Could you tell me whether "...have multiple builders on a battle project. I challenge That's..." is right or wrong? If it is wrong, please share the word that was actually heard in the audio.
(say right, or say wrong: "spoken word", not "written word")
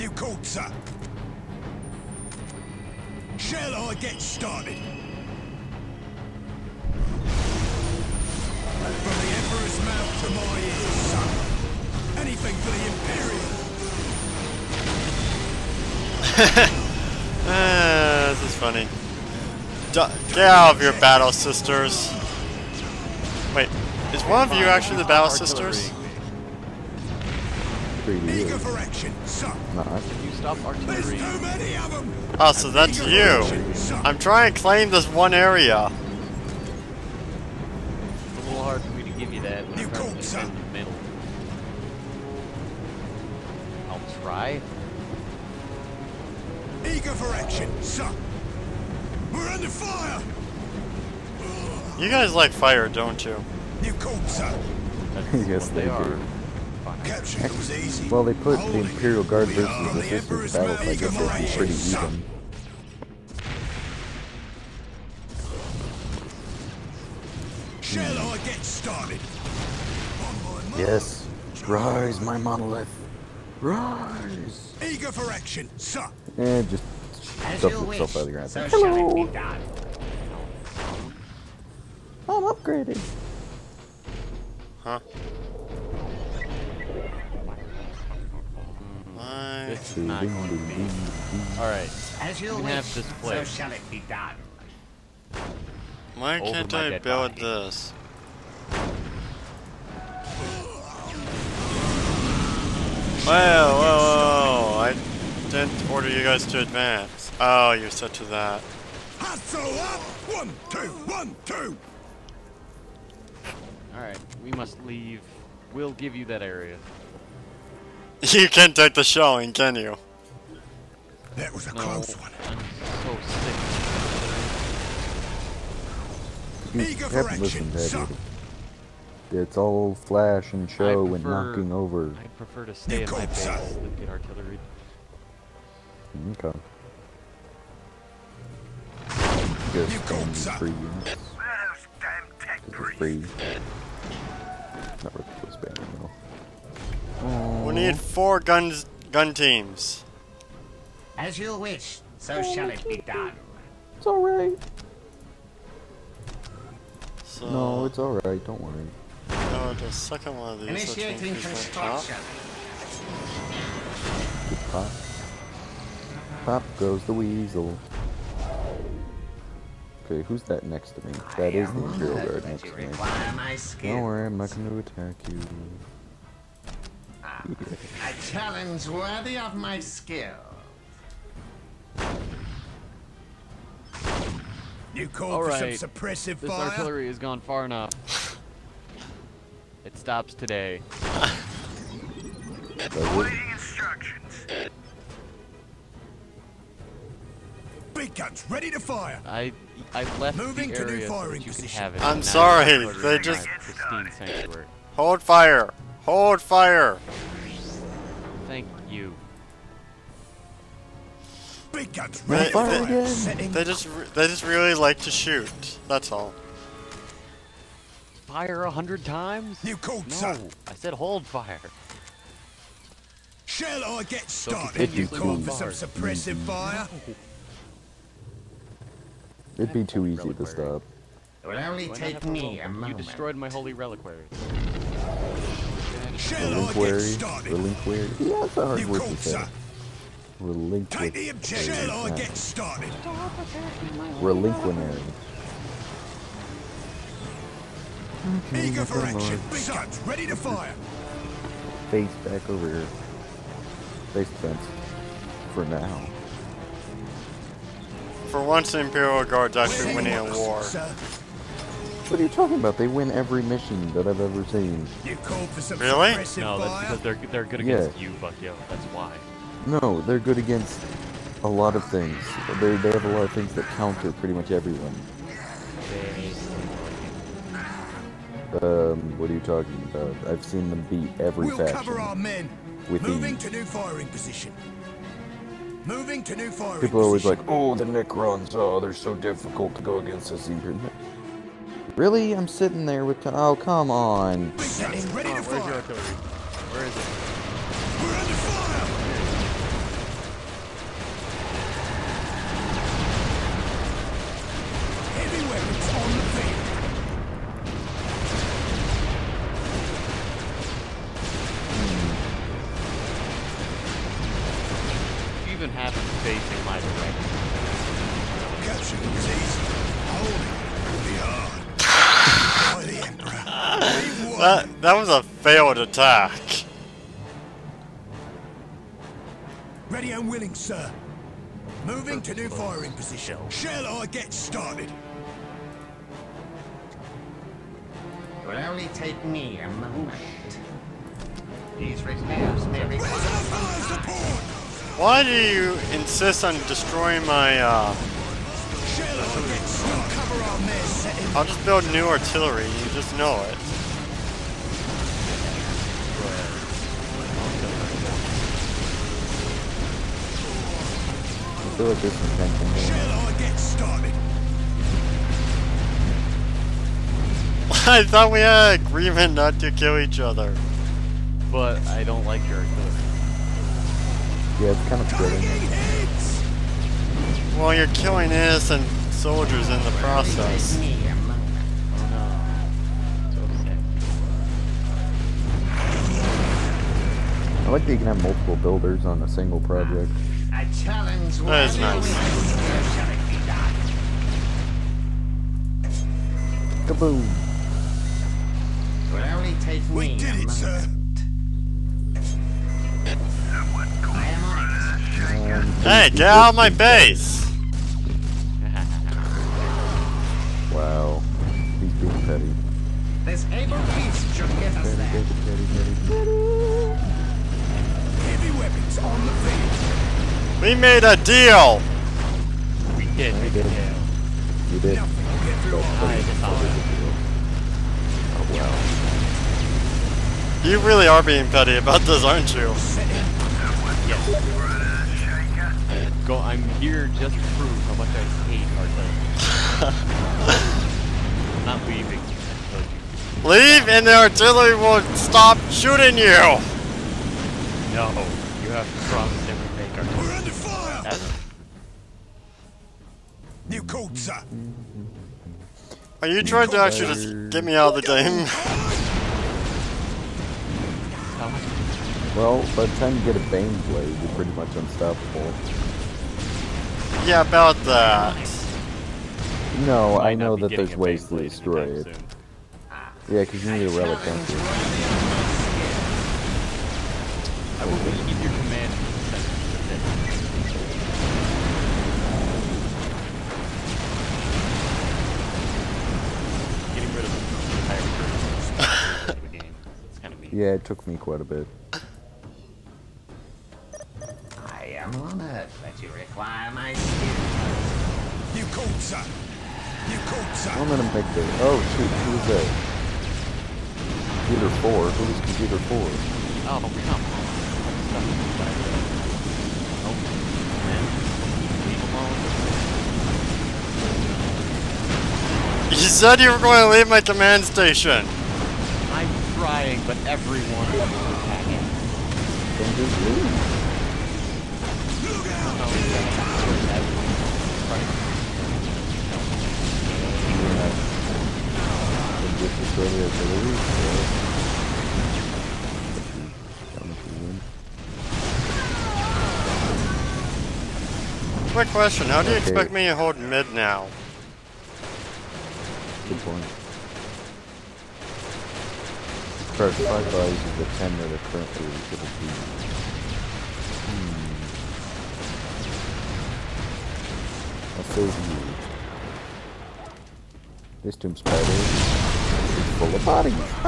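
wrong: "single", not "battle".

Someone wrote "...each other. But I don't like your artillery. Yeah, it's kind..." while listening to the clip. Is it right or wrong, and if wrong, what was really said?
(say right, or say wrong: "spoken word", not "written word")
right.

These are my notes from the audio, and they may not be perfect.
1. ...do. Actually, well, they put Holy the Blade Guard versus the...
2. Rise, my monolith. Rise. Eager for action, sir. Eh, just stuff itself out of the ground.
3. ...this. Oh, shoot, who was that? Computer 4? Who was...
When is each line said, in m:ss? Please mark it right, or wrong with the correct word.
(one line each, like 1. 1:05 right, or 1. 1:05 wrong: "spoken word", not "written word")
1. 0:56 wrong: "Imperial", not "Blade"
2. 1:11 right
3. 8:21 right.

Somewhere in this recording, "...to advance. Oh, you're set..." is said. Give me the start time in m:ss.
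1:46.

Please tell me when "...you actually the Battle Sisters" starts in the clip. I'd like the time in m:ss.
0:24.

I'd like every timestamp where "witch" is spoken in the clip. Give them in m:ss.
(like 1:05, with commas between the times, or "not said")
not said.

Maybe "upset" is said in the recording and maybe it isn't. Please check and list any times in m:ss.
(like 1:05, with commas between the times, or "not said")
not said.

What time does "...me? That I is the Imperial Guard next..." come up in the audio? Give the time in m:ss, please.
2:51.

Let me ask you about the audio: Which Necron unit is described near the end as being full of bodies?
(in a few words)
Tomb spider.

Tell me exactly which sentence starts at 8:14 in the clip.
I am honored that you require my skills.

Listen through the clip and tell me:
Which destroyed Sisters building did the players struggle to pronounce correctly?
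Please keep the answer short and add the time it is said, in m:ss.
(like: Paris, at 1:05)
Holy reliquary, at 3:53.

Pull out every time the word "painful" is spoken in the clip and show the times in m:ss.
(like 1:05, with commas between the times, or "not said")
not said.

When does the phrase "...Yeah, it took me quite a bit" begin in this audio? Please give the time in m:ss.
8:10.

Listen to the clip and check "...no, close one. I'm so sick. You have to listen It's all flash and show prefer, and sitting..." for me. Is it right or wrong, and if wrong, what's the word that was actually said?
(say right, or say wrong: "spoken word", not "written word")
wrong: "knocking", not "sitting".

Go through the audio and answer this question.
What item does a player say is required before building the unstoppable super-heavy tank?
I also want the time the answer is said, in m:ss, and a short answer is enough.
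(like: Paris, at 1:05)
A relic, at 7:53.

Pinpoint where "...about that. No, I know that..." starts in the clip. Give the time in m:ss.
7:47.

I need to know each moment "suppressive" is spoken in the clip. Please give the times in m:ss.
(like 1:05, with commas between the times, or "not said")
3:05, 3:45.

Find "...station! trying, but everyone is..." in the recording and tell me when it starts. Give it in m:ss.
8:37.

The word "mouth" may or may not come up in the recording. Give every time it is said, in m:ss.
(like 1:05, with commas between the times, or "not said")
0:09.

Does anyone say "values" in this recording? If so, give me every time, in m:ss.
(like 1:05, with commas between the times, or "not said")
9:10.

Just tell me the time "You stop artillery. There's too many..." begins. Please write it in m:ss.
0:30.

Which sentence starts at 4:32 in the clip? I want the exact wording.
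They they have a lot of things that counter pretty much everyone.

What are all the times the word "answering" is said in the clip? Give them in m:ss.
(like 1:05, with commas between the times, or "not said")
not said.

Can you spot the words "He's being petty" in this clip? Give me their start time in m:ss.
6:51.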